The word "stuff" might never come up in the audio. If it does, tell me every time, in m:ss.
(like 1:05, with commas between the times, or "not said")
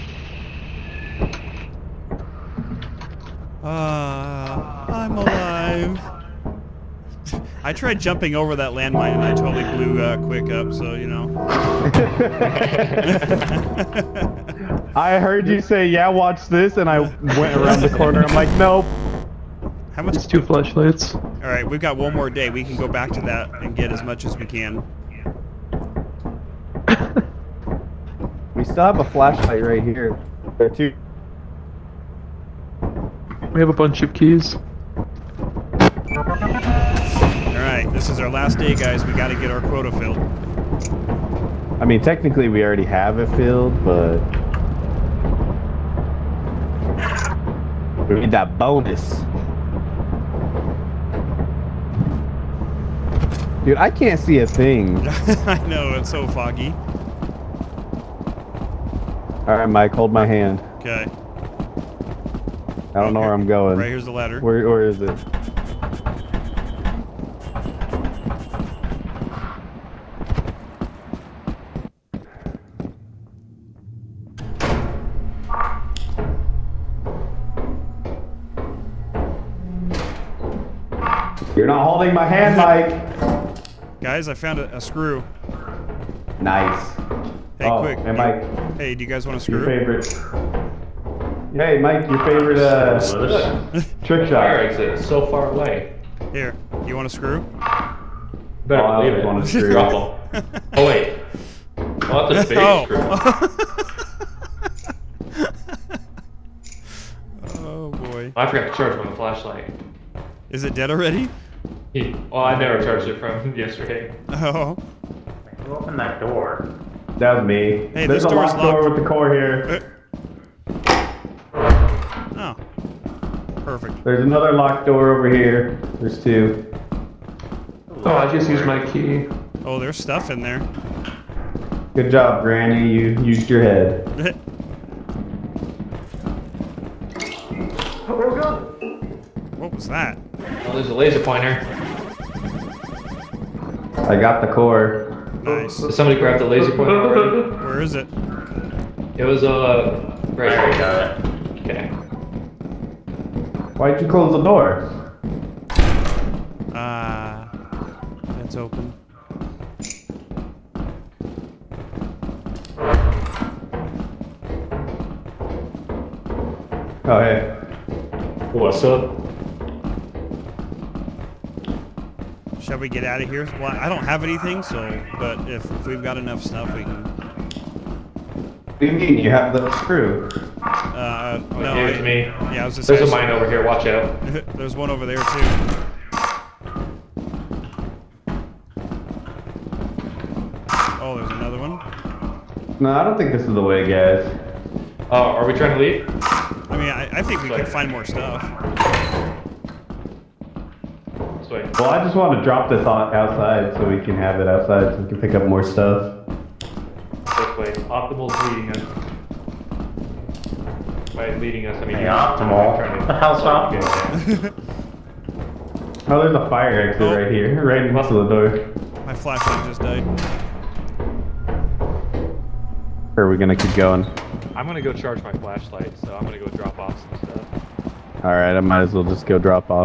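2:09, 2:56, 3:18, 3:25, 3:47.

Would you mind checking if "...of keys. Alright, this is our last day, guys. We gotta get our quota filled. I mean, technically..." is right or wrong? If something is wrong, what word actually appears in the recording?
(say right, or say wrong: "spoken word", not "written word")
right.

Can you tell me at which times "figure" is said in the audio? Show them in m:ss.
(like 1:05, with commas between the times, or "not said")
not said.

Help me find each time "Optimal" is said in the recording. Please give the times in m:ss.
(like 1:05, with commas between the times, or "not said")
3:27, 3:32.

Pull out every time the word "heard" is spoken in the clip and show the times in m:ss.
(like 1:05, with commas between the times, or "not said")
0:15.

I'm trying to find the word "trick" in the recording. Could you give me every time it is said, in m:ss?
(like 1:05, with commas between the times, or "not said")
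1:34.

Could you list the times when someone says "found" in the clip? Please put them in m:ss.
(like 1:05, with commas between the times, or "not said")
1:24.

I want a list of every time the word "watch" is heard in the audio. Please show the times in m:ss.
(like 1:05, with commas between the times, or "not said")
0:16, 3:03.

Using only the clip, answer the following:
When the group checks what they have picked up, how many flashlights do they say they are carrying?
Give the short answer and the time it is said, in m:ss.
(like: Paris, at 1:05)
2, at 0:20.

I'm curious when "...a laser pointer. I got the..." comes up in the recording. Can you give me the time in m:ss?
2:20.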